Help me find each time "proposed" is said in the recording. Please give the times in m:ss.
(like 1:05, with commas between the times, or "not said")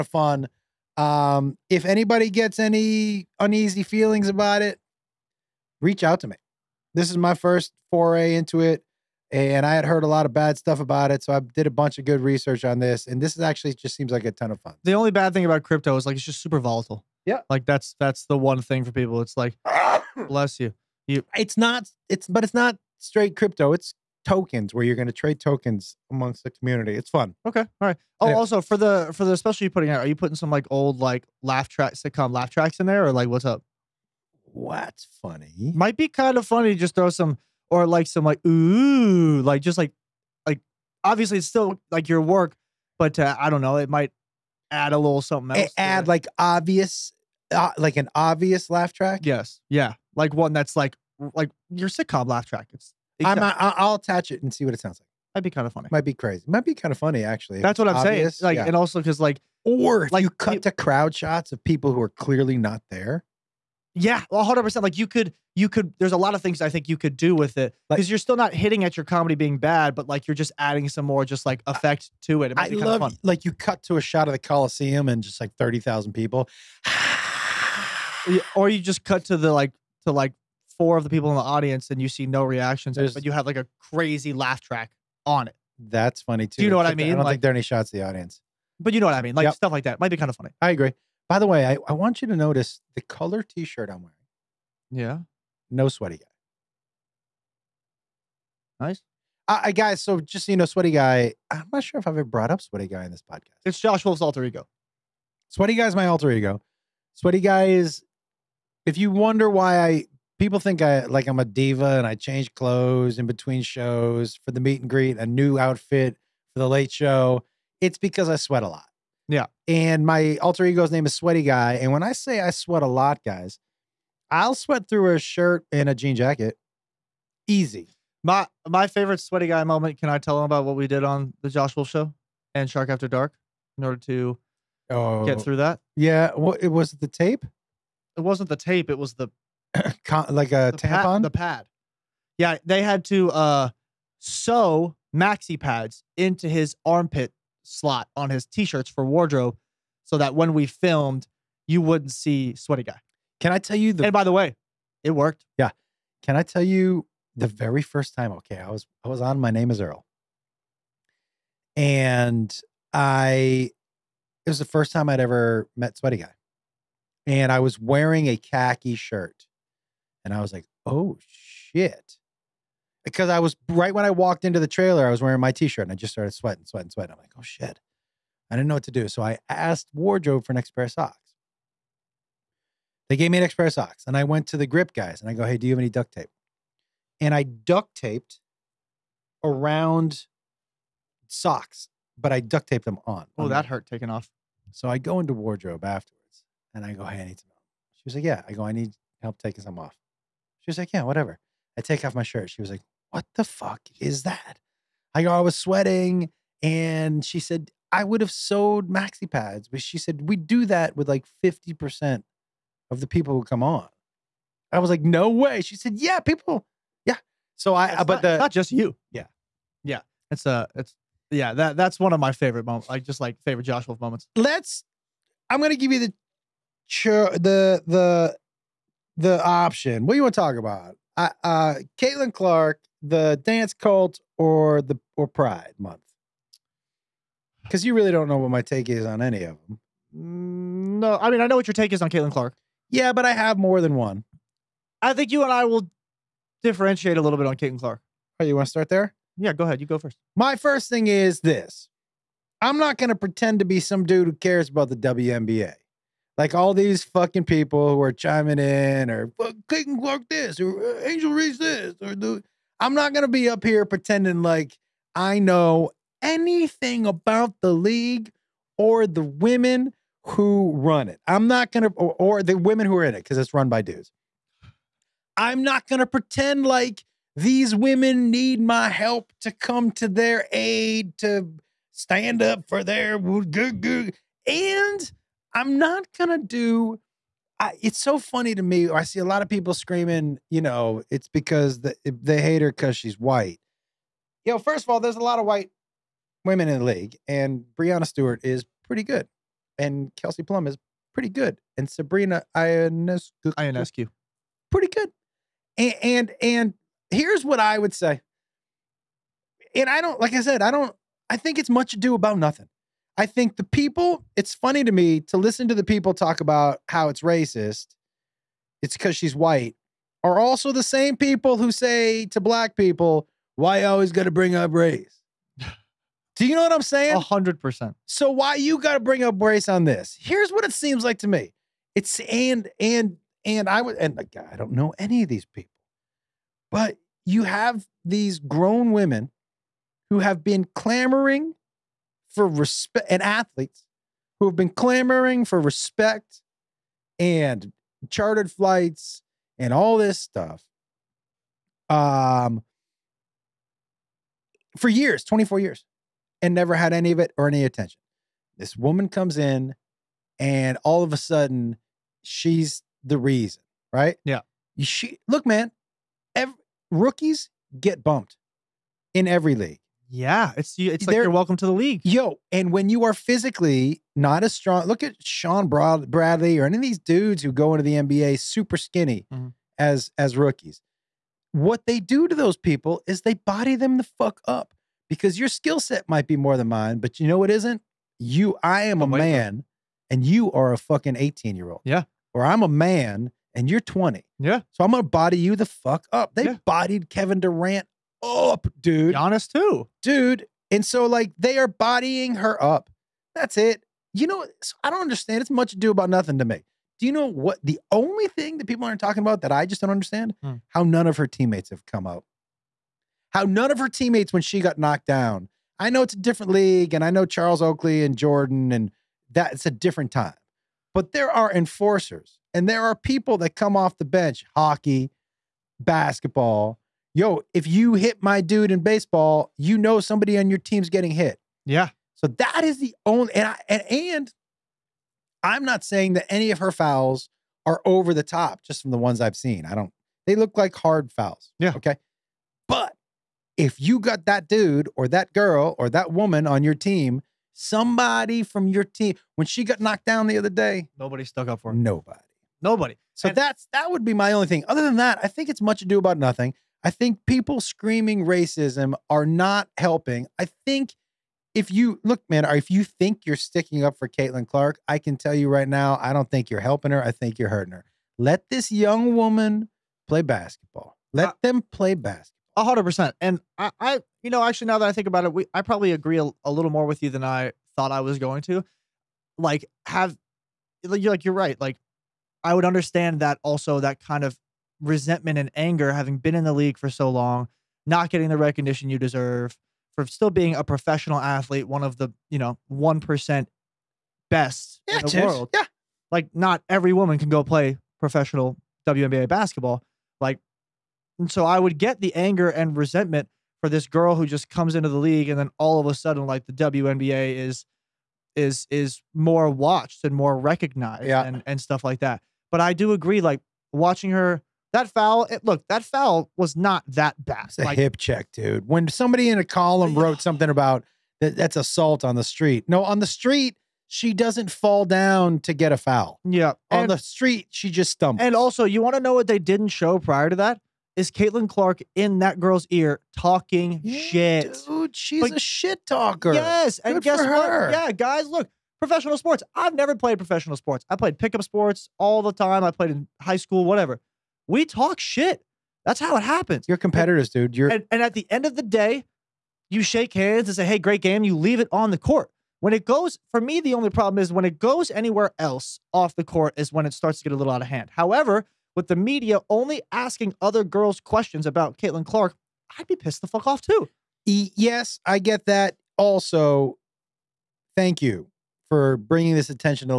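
not said.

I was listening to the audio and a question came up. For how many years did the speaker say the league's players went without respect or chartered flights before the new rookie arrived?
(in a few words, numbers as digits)
24.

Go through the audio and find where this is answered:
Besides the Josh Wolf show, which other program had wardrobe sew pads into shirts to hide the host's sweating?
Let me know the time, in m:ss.
2:12.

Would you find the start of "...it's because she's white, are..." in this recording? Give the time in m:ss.
5:18.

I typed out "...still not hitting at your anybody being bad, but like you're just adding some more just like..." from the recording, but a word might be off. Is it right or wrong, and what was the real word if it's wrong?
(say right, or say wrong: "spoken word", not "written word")
wrong: "comedy", not "anybody".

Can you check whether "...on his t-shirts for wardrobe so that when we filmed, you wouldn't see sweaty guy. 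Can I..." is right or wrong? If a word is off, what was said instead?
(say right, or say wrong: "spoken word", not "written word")
right.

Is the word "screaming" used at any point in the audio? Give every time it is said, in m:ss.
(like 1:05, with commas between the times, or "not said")
4:49, 7:37.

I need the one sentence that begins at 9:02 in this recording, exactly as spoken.
I played in high school, whatever.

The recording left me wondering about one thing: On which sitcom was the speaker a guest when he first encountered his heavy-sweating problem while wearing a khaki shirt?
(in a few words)
My Name Is Earl.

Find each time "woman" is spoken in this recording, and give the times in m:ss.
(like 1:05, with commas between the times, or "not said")
5:58, 7:26, 7:49, 8:16.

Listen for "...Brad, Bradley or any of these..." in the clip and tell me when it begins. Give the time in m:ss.
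6:15.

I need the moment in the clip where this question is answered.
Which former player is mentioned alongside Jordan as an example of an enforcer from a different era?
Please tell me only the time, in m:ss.
6:57.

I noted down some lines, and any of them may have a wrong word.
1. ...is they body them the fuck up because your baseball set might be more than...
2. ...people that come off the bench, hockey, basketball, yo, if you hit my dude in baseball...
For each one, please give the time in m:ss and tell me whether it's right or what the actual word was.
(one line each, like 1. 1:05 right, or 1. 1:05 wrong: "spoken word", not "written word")
1. 6:23 wrong: "skill", not "baseball"
2. 7:02 right.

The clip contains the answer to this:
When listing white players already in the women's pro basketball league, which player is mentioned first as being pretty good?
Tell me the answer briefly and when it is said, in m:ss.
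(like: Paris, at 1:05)
Breanna Stewart, at 4:57.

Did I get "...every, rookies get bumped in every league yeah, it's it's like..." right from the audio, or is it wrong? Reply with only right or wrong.
right.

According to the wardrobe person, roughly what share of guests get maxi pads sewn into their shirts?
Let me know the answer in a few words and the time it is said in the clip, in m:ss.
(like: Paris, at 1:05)
50%, at 3:31.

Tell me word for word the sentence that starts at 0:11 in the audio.
So I did a bunch of good research on this, and this is actually just seems like a ton of fun.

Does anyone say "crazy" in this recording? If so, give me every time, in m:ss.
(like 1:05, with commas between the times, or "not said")
0:56, 1:23.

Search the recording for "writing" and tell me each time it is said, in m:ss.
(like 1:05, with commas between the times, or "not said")
not said.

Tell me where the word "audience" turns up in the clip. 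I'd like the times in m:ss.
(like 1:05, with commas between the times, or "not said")
1:21, 1:28.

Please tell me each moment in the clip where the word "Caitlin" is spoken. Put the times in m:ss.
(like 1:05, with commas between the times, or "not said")
3:51, 4:02, 4:07, 4:19, 7:44, 8:51, 9:21.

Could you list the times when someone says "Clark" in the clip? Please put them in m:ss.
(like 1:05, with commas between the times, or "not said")
3:52, 4:02, 4:07, 4:19, 7:44, 8:51, 9:22.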